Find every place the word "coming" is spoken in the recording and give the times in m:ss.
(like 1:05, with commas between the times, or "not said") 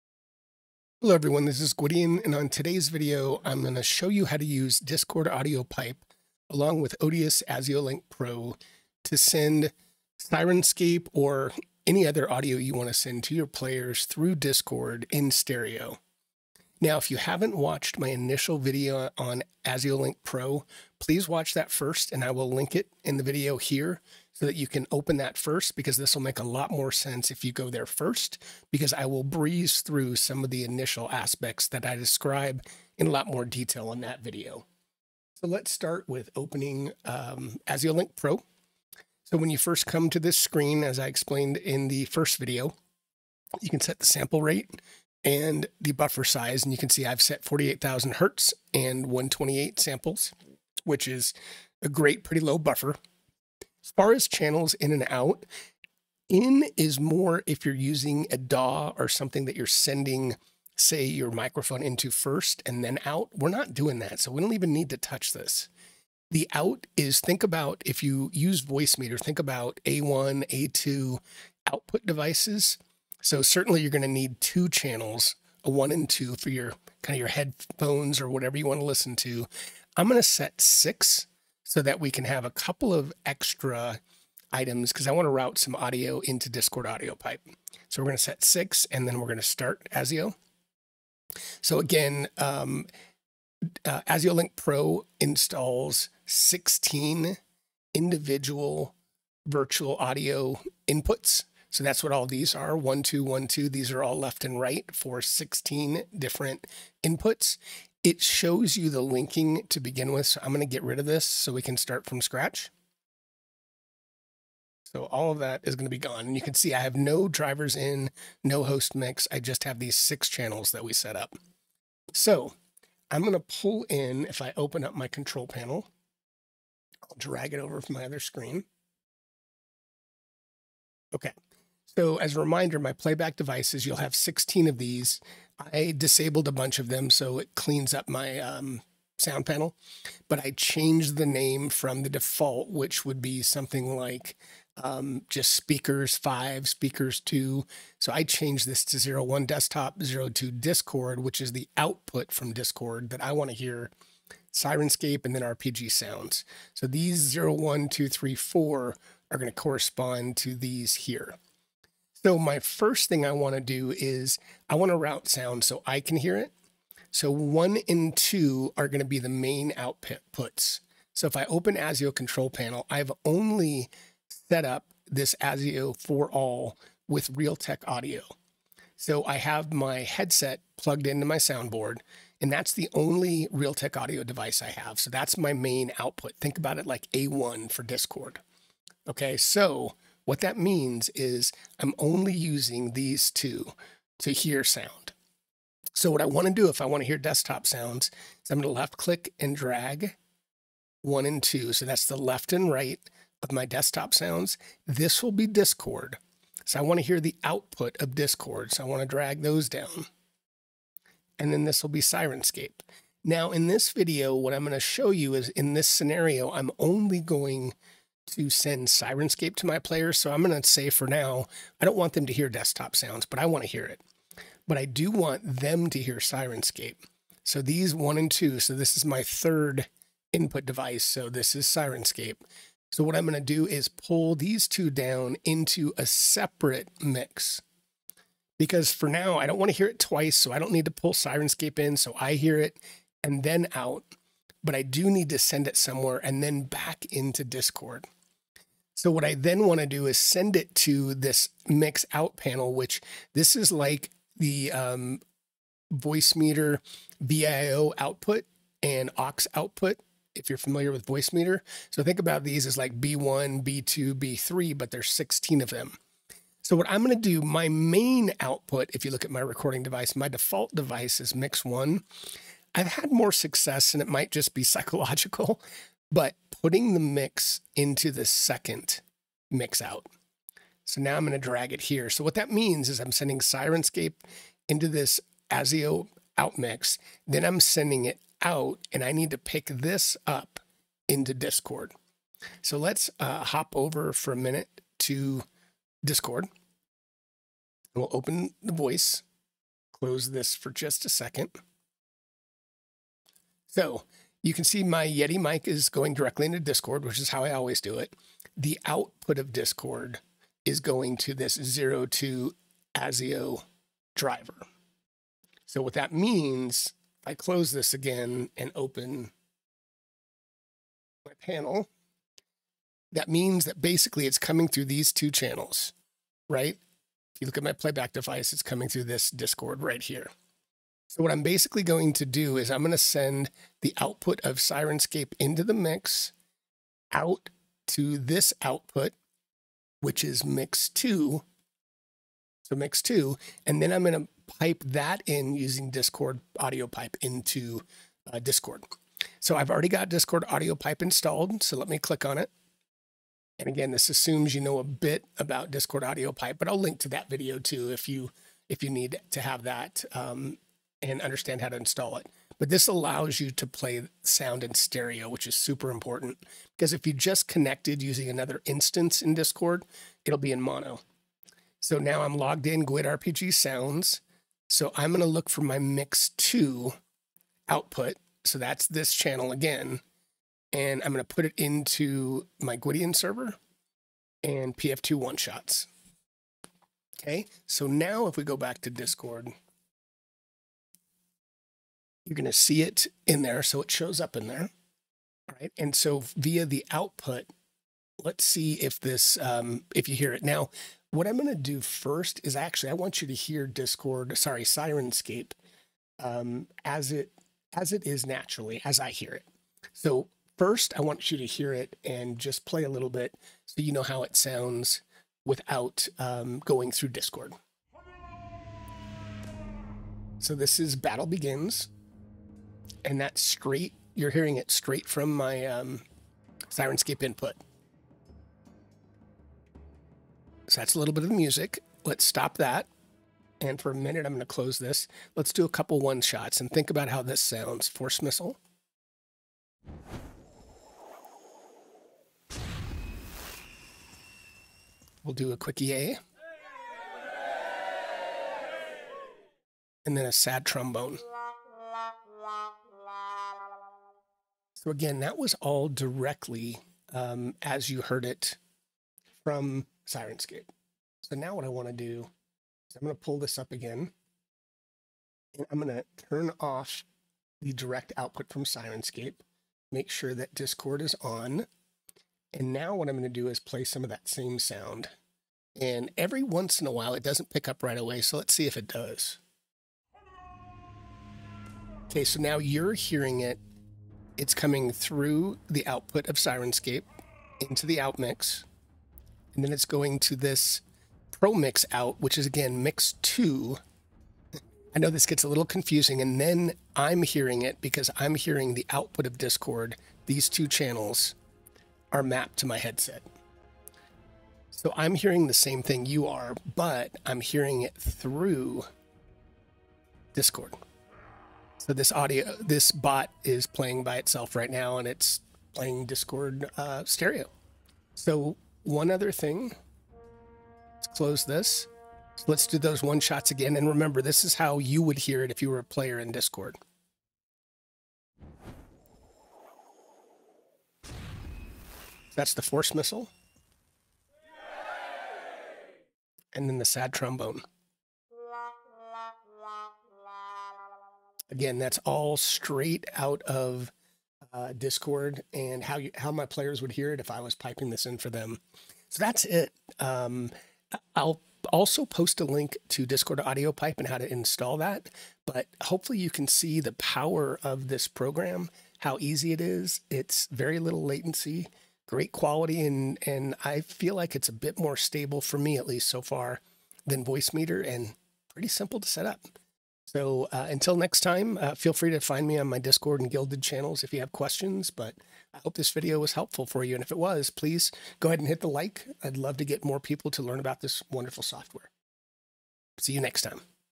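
5:24, 5:28, 8:04.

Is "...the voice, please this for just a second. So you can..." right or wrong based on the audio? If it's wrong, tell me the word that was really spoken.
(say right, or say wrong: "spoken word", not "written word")
wrong: "close", not "please".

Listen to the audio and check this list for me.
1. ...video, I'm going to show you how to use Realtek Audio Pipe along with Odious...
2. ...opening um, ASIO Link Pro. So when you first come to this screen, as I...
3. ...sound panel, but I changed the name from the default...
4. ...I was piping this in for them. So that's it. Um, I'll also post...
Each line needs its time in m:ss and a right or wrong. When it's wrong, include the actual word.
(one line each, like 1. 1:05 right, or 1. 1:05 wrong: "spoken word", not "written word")
1. 0:02 wrong: "Discord", not "Realtek"
2. 0:36 right
3. 2:19 right
4. 9:07 right.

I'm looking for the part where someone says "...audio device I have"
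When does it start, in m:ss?
3:03.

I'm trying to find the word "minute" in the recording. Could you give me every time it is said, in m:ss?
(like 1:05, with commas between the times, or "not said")
4:54, 7:13.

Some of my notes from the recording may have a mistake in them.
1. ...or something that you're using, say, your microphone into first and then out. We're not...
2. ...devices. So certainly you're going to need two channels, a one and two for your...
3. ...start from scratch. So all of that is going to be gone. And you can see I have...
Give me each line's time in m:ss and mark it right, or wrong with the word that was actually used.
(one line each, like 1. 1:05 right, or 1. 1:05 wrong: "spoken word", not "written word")
1. 0:58 wrong: "sending", not "using"
2. 1:12 right
3. 1:51 right.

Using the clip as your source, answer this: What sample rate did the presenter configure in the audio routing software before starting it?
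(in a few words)
48,000 Hertz.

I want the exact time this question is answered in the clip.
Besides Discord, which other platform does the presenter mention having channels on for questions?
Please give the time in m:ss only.
9:33.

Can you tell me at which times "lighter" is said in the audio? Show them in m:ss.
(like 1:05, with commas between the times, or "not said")
not said.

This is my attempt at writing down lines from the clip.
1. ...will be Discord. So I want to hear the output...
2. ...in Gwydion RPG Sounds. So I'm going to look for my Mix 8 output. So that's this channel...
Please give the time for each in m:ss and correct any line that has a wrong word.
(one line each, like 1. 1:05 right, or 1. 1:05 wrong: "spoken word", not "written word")
1. 3:25 right
2. 6:12 wrong: "2", not "8".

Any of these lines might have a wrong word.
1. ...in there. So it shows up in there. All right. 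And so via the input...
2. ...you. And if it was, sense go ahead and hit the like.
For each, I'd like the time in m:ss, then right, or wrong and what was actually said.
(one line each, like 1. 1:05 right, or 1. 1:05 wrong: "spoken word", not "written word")
1. 6:33 wrong: "output", not "input"
2. 9:36 wrong: "please", not "sense".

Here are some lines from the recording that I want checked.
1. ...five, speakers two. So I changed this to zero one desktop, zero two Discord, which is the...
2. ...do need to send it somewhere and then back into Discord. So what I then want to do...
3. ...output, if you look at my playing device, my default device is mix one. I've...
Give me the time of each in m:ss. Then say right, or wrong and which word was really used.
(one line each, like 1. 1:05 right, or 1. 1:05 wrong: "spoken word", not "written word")
1. 2:26 right
2. 4:04 right
3. 4:28 wrong: "recording", not "playing".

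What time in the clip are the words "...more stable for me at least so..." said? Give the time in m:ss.
9:24.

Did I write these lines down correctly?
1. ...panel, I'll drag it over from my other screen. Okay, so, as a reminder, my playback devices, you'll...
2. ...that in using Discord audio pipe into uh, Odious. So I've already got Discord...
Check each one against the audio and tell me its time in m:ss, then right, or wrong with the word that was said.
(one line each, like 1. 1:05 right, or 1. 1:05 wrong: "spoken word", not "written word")
1. 2:05 right
2. 5:44 wrong: "Discord", not "Odious".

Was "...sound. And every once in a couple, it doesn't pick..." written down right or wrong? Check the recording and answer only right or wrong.
wrong.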